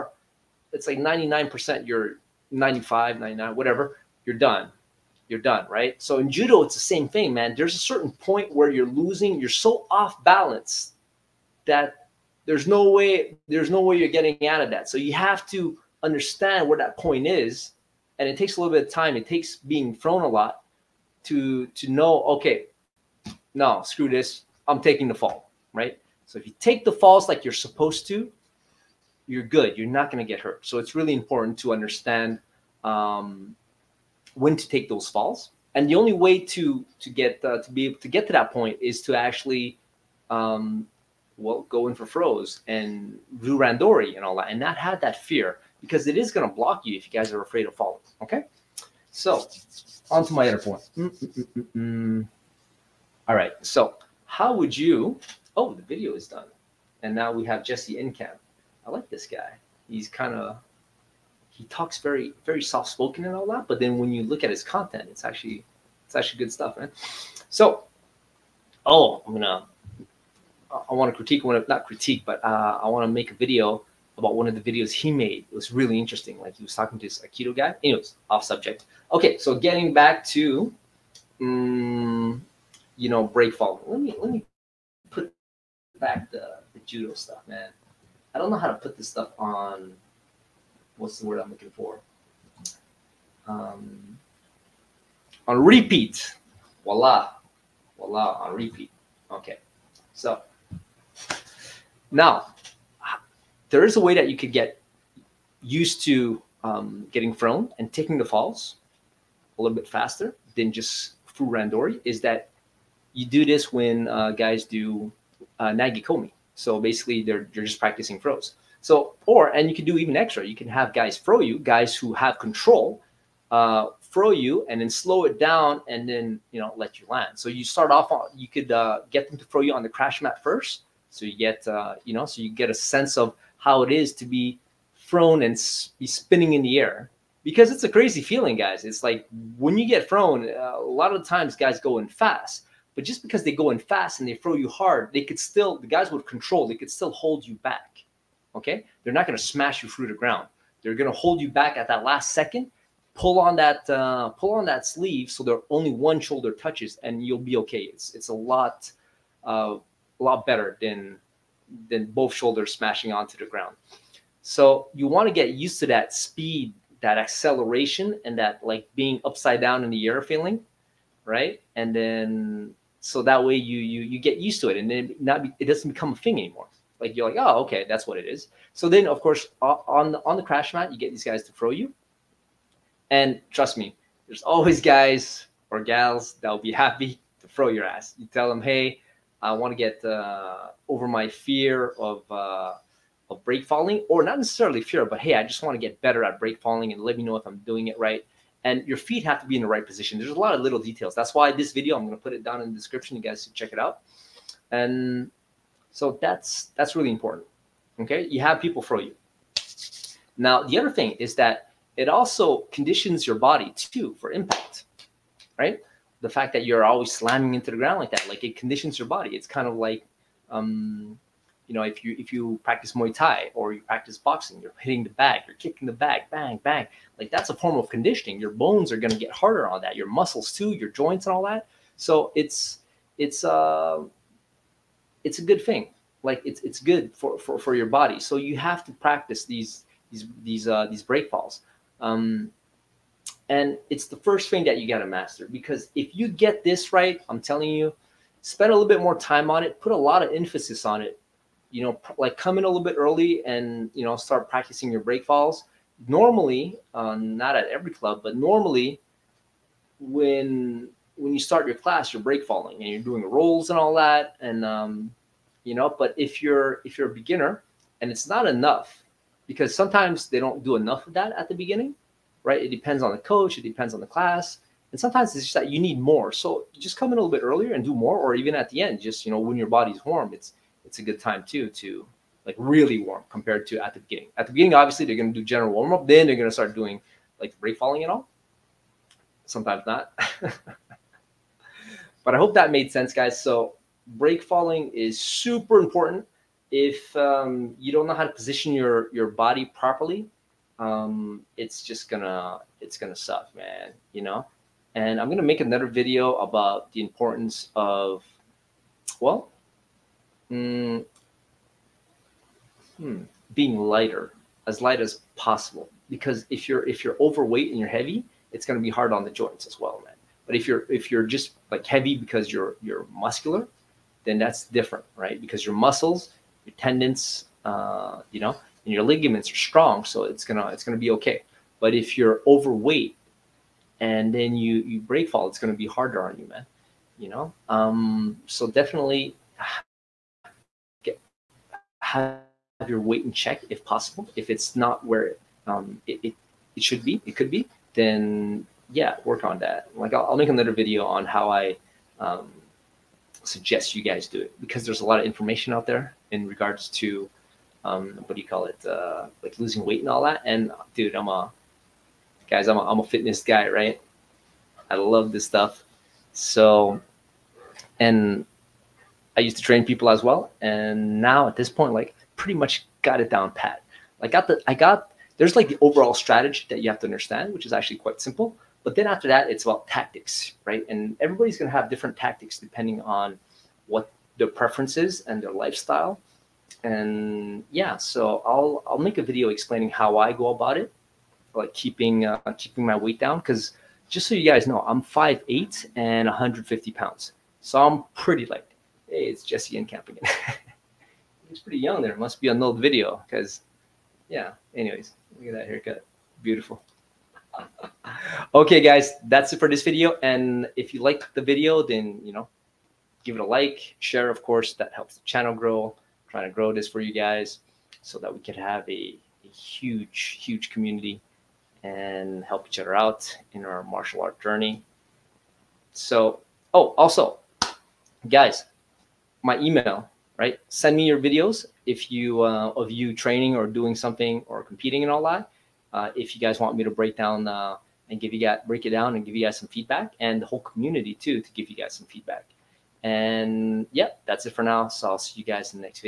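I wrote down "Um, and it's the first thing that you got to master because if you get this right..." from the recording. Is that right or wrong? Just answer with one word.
right.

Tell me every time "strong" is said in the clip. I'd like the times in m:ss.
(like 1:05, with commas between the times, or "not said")
5:29.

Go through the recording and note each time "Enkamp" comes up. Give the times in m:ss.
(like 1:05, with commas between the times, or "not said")
0:57, 6:39.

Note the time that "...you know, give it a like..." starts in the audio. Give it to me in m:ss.
6:52.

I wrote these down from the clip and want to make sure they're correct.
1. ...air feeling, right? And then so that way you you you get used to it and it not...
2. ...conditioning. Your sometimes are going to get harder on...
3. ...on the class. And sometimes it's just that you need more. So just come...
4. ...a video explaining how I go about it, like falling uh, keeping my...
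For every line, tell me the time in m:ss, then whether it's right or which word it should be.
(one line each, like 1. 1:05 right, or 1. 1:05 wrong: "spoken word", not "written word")
1. 2:50 right
2. 3:47 wrong: "bones", not "sometimes"
3. 4:33 right
4. 6:29 wrong: "keeping", not "falling".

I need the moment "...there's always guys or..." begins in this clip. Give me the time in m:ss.
3:04.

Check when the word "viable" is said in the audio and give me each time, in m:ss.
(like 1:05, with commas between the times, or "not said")
not said.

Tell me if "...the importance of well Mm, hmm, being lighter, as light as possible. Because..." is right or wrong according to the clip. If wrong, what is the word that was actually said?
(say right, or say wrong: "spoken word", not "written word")
right.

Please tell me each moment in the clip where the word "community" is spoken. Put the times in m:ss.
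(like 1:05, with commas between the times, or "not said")
7:00, 7:20.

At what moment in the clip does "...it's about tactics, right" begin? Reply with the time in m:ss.
6:19.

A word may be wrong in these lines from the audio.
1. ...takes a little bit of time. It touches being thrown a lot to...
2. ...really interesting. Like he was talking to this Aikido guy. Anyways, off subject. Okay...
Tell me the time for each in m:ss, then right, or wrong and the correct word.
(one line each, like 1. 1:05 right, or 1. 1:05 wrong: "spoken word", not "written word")
1. 0:18 wrong: "takes", not "touches"
2. 1:15 right.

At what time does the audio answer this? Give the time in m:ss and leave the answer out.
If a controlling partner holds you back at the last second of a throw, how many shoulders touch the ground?
2:35.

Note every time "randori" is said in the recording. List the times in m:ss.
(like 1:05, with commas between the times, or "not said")
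0:43, 1:51.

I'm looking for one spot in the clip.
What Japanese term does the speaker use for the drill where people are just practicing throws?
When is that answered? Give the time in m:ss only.
1:55.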